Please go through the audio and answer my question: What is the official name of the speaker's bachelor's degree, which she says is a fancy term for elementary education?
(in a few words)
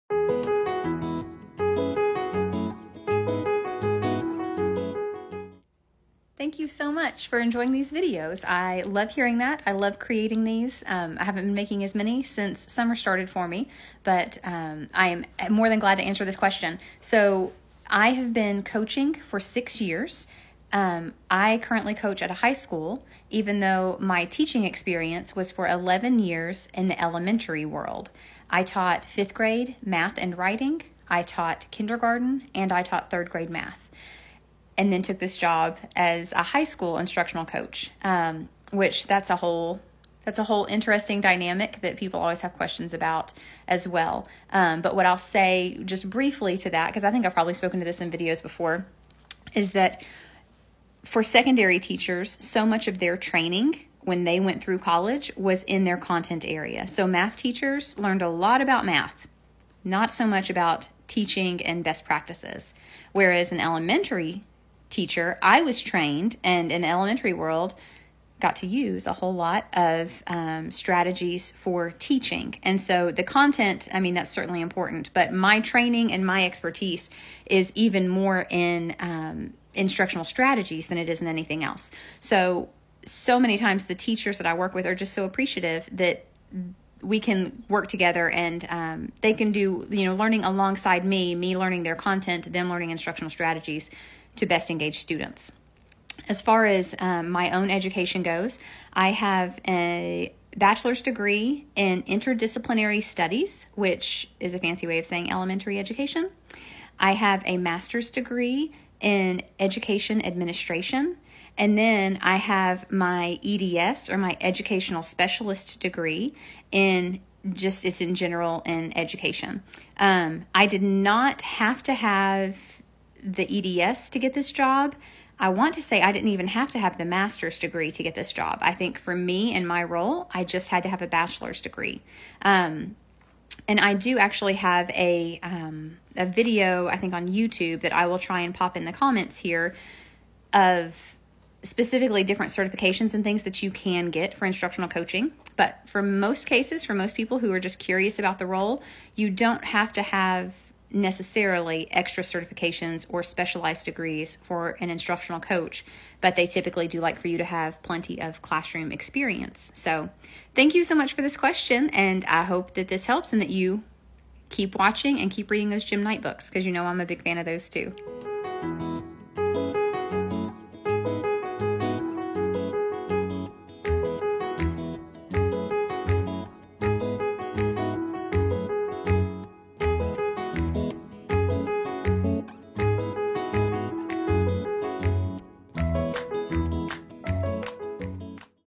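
Interdisciplinary studies.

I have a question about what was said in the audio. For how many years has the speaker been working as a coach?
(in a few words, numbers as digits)
6 years.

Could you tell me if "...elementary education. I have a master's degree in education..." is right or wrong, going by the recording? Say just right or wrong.
right.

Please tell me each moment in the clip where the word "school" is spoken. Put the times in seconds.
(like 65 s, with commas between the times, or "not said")
22 s, 36 s.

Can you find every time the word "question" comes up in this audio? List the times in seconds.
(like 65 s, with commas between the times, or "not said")
16 s, 42 s, 161 s.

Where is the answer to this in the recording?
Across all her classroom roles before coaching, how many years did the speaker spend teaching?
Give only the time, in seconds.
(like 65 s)
25 s.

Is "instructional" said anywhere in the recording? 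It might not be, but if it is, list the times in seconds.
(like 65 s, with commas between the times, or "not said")
36 s, 79 s, 92 s, 144 s, 154 s.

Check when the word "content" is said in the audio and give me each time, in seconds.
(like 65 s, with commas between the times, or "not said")
55 s, 73 s, 91 s.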